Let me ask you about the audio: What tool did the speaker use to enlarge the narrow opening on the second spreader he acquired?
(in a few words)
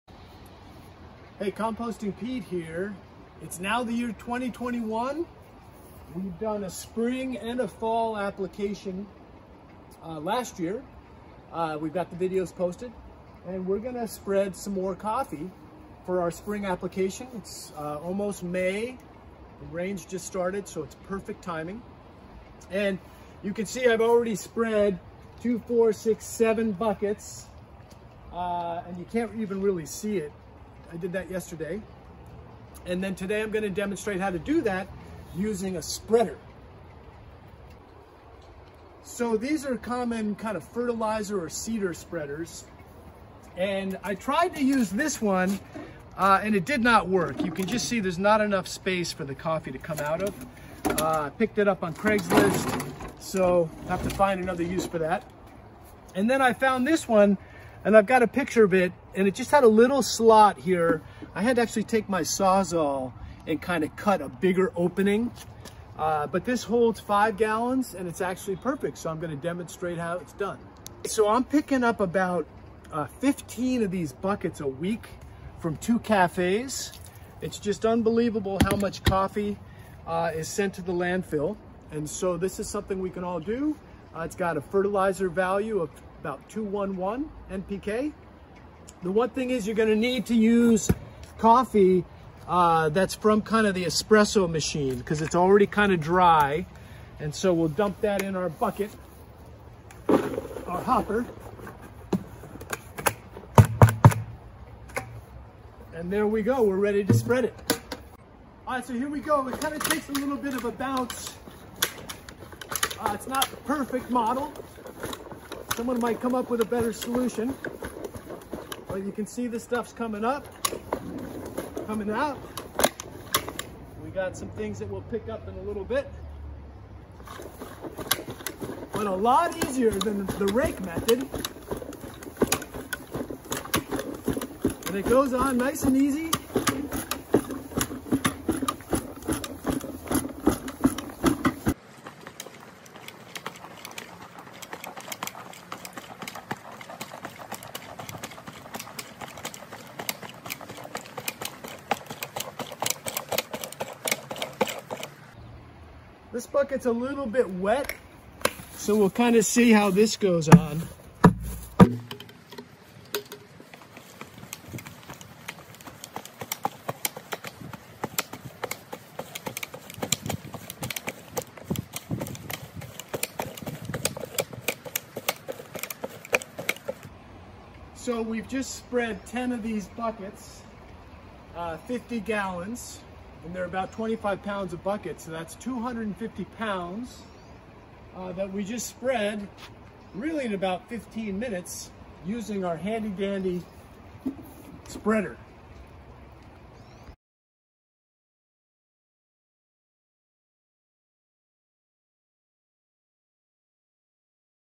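Sawzall.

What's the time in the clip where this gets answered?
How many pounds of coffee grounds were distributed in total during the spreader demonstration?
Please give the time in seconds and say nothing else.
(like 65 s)
185 s.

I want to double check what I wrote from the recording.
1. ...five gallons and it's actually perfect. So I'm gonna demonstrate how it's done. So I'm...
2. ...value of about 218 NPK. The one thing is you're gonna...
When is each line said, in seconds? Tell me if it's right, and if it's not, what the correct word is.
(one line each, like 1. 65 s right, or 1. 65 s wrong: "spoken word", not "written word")
1. 66 s right
2. 85 s wrong: "211", not "218".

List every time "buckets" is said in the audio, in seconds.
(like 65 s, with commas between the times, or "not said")
26 s, 74 s, 98 s, 156 s, 179 s, 184 s.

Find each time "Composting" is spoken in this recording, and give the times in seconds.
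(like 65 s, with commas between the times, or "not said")
1 s.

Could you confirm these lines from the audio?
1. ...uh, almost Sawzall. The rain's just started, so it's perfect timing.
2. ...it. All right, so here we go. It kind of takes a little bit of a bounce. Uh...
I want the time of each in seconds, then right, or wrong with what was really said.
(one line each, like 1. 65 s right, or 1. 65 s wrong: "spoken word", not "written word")
1. 17 s wrong: "May", not "Sawzall"
2. 107 s right.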